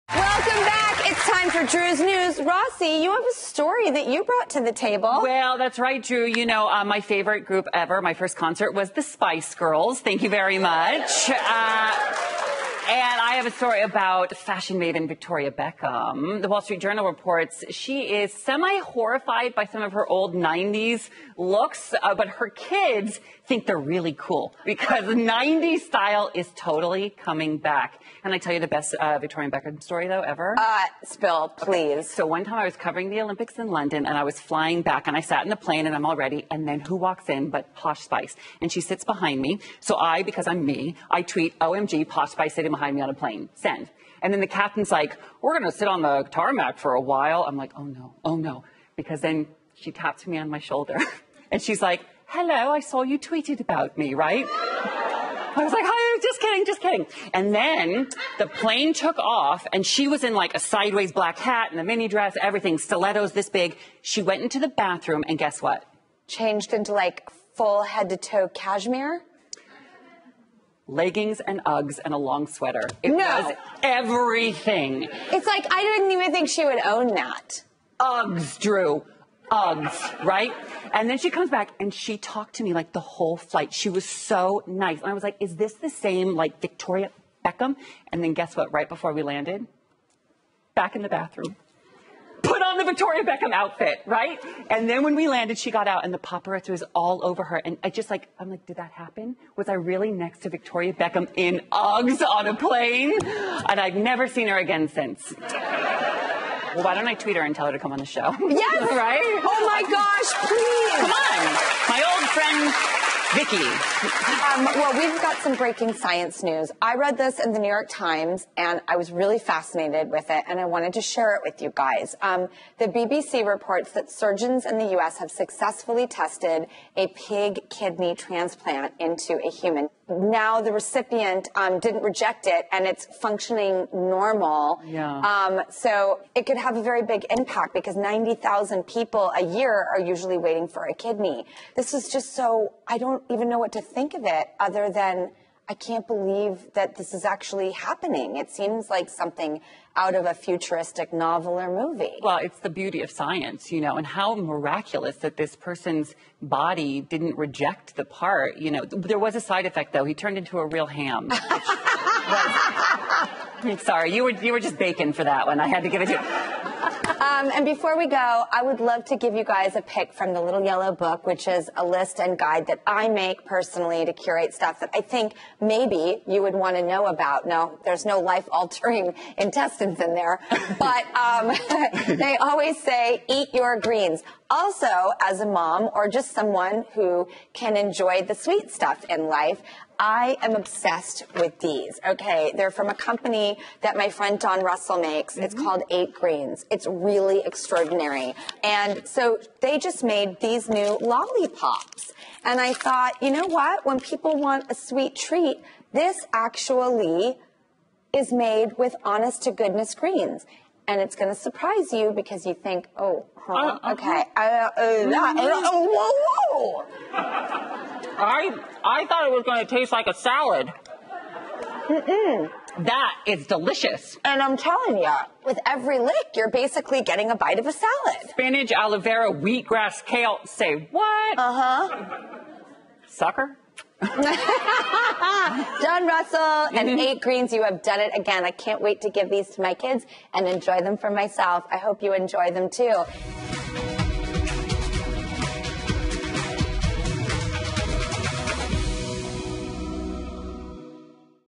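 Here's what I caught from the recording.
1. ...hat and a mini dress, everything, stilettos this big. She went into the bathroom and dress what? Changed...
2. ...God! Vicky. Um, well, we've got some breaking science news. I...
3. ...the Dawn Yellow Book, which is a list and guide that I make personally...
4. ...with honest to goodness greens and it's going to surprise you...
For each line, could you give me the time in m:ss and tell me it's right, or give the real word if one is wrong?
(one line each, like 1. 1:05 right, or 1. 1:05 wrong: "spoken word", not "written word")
1. 1:01 wrong: "guess", not "dress"
2. 1:49 right
3. 2:50 wrong: "Little", not "Dawn"
4. 3:28 right.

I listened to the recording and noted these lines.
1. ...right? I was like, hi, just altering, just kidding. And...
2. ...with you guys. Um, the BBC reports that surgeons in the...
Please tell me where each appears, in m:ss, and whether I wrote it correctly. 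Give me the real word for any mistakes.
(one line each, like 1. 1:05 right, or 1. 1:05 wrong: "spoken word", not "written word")
1. 0:54 wrong: "kidding", not "altering"
2. 2:01 right.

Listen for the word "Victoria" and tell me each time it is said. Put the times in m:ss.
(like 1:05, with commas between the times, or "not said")
0:15, 0:29, 1:26, 1:32, 1:40.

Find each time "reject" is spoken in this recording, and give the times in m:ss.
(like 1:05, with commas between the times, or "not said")
2:12, 2:37.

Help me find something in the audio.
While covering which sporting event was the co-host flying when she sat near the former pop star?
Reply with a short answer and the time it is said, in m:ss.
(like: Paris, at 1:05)
Olympics in London, at 0:33.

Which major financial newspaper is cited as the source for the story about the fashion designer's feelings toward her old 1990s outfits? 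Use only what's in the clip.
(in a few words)
The Wall Street Journal.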